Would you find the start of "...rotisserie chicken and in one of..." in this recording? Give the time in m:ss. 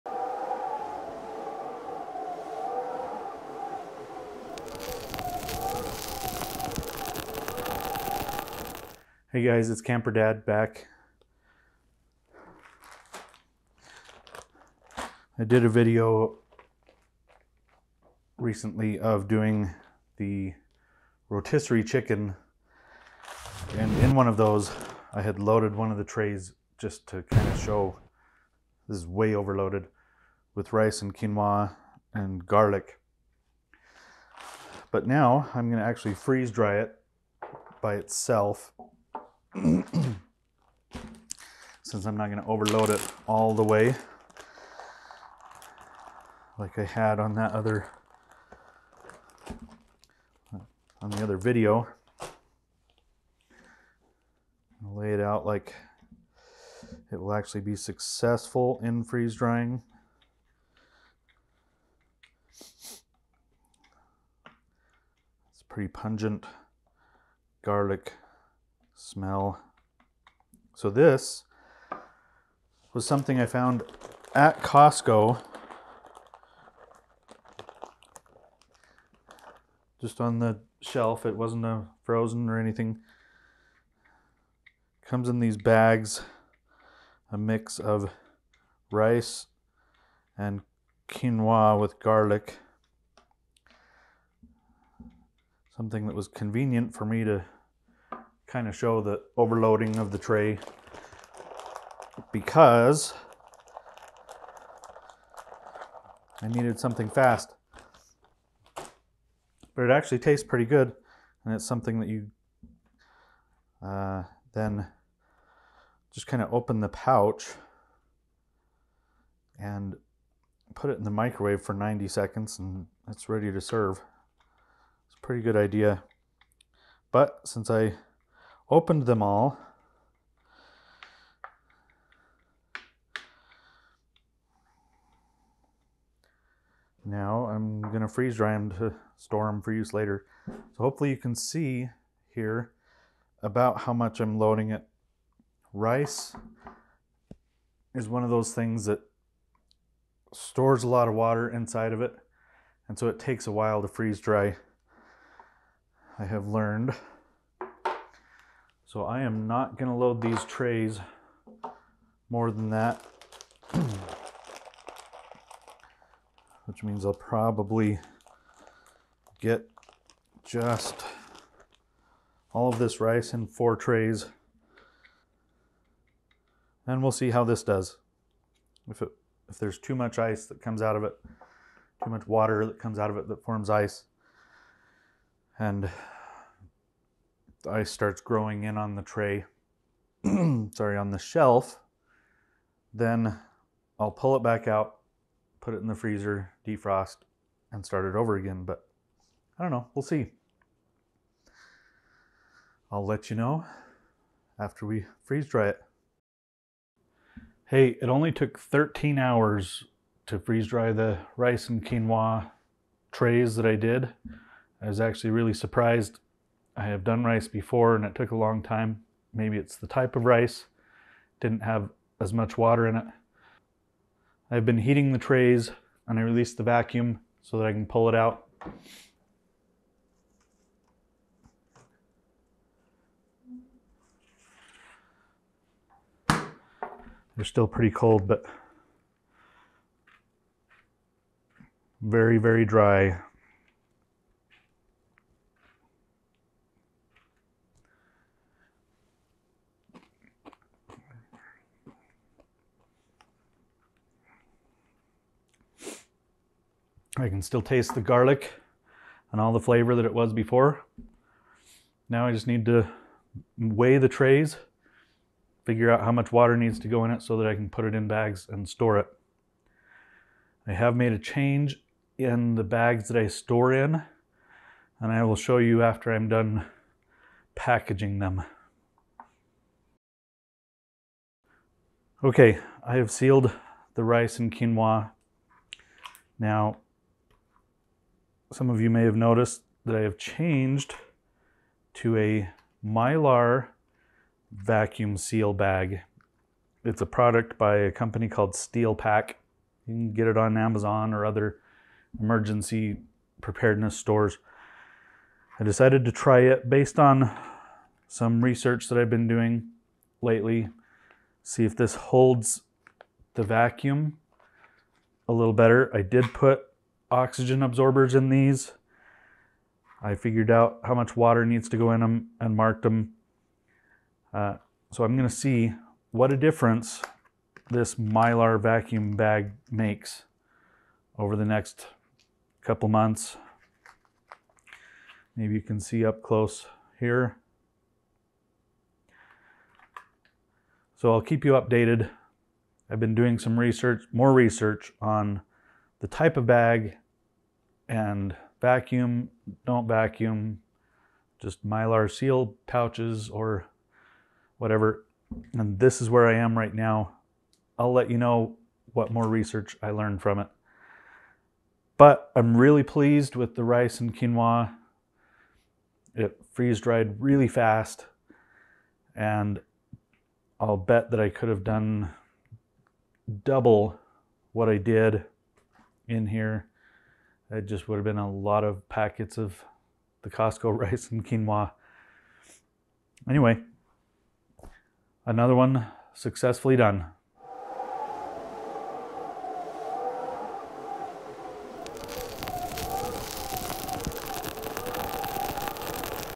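0:21.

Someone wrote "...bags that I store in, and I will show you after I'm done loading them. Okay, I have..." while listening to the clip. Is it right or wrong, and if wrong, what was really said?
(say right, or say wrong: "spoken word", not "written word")
wrong: "packaging", not "loading".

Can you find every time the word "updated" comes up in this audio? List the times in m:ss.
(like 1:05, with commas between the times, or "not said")
5:41.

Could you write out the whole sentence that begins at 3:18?
But I don't know, we'll see.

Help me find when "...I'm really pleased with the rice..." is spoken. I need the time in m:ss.
6:02.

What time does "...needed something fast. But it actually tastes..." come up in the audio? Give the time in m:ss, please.
1:46.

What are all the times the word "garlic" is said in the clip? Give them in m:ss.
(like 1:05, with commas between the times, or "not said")
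0:32, 1:07, 1:31, 4:18.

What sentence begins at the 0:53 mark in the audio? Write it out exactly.
I'll lay it out like it will actually be successful in freeze drying.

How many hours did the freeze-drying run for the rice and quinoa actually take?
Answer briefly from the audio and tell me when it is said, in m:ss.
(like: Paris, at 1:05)
13 hours, at 3:28.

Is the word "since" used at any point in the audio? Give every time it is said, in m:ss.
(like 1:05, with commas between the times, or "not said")
0:41, 2:07.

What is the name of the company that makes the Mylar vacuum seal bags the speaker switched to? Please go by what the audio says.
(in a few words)
Steel Pack.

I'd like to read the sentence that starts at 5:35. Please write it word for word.
Maybe you can see up close here.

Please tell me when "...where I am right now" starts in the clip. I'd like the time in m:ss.
5:56.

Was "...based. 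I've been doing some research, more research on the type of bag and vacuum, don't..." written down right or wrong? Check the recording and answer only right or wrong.
wrong.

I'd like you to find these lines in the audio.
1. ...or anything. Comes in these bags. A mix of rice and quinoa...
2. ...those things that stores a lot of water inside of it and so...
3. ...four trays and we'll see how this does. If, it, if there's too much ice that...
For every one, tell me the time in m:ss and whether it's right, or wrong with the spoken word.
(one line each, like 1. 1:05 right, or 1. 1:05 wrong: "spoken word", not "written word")
1. 1:22 right
2. 2:28 right
3. 2:53 right.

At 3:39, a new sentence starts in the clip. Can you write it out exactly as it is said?
Maybe it's the type of rice, didn't have as much water in it.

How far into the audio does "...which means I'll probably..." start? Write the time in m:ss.
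2:46.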